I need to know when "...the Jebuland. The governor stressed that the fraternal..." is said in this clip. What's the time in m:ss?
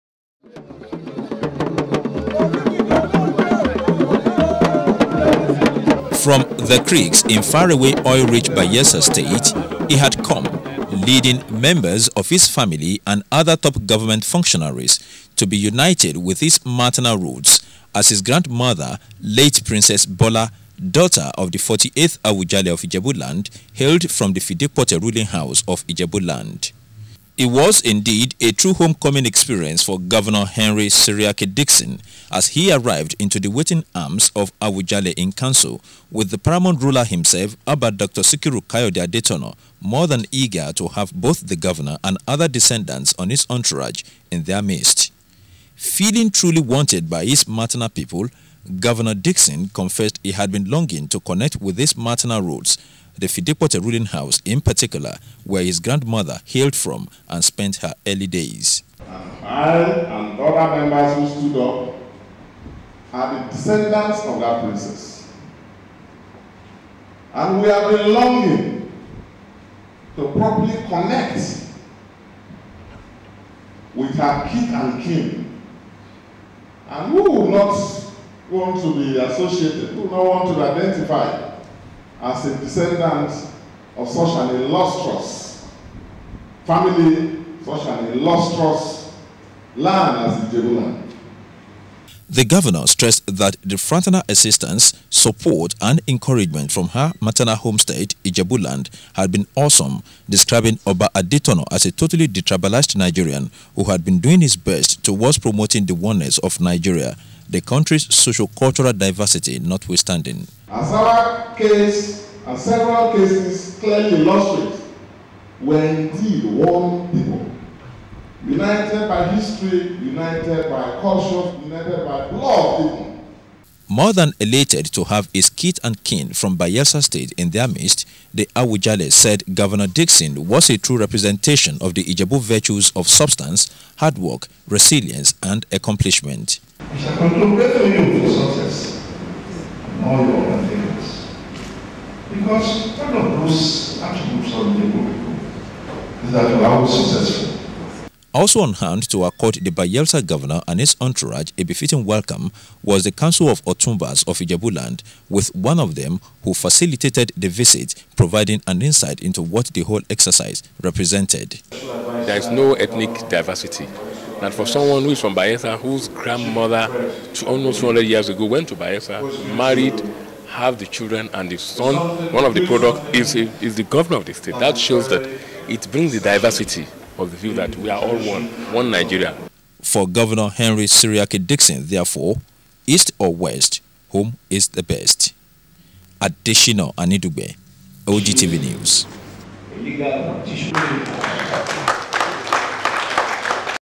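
1:30.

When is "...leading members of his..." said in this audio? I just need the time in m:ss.
0:11.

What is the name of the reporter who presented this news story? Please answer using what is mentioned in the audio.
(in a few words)
Adesina Anidugbe.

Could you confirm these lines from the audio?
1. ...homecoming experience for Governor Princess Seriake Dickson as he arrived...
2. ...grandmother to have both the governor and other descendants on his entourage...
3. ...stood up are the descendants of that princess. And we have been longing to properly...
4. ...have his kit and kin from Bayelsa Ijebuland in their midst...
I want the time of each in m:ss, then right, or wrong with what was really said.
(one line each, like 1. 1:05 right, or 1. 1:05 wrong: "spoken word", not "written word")
1. 0:28 wrong: "Henry", not "Princess"
2. 0:40 wrong: "eager", not "grandmother"
3. 1:01 right
4. 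2:05 wrong: "State", not "Ijebuland".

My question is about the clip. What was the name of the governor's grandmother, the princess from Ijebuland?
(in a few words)
Princess Bola.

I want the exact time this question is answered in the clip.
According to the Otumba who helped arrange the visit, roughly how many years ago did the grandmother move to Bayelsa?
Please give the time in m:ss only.
2:47.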